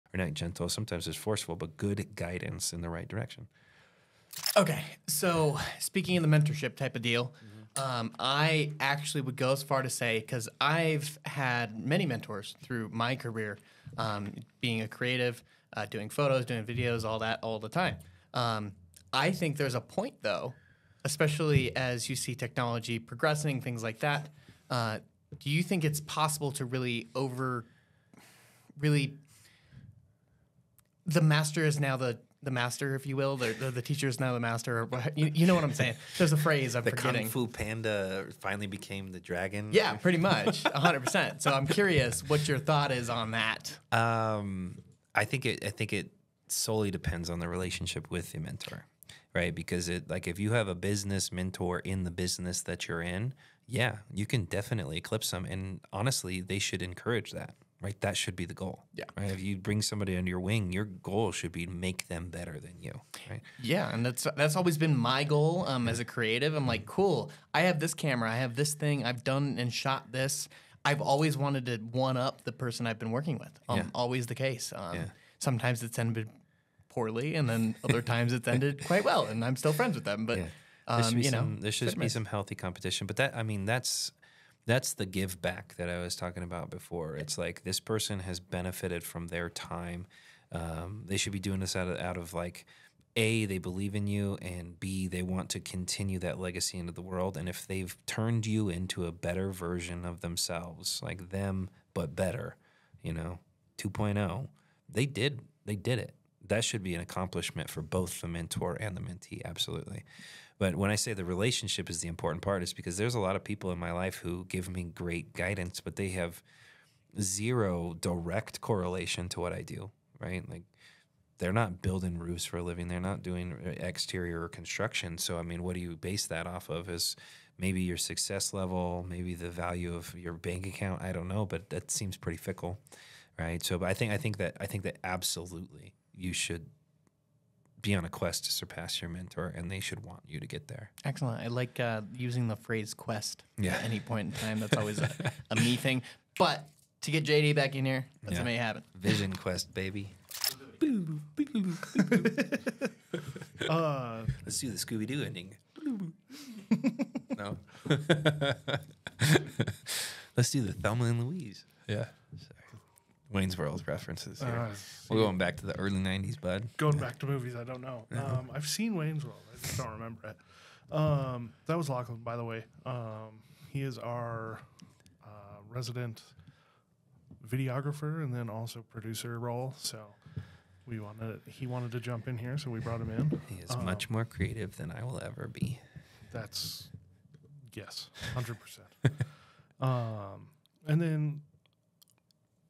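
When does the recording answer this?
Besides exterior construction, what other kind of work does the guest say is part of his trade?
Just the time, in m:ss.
2:01.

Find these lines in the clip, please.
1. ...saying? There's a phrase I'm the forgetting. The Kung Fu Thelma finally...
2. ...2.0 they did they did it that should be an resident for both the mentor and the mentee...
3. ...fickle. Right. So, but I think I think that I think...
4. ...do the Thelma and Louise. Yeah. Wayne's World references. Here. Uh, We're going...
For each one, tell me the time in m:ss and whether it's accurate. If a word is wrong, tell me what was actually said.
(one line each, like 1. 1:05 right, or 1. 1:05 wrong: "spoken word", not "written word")
1. 0:35 wrong: "Panda", not "Thelma"
2. 1:43 wrong: "accomplishment", not "resident"
3. 2:12 right
4. 2:40 right.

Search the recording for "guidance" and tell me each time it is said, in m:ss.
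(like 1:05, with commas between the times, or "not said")
0:02, 1:55.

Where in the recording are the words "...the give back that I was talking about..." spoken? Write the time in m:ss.
1:24.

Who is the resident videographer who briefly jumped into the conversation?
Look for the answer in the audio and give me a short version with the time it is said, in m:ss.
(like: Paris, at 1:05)
Lachlan, at 2:51.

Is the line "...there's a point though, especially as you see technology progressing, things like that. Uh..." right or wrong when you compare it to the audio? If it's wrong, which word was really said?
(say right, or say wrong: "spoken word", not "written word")
right.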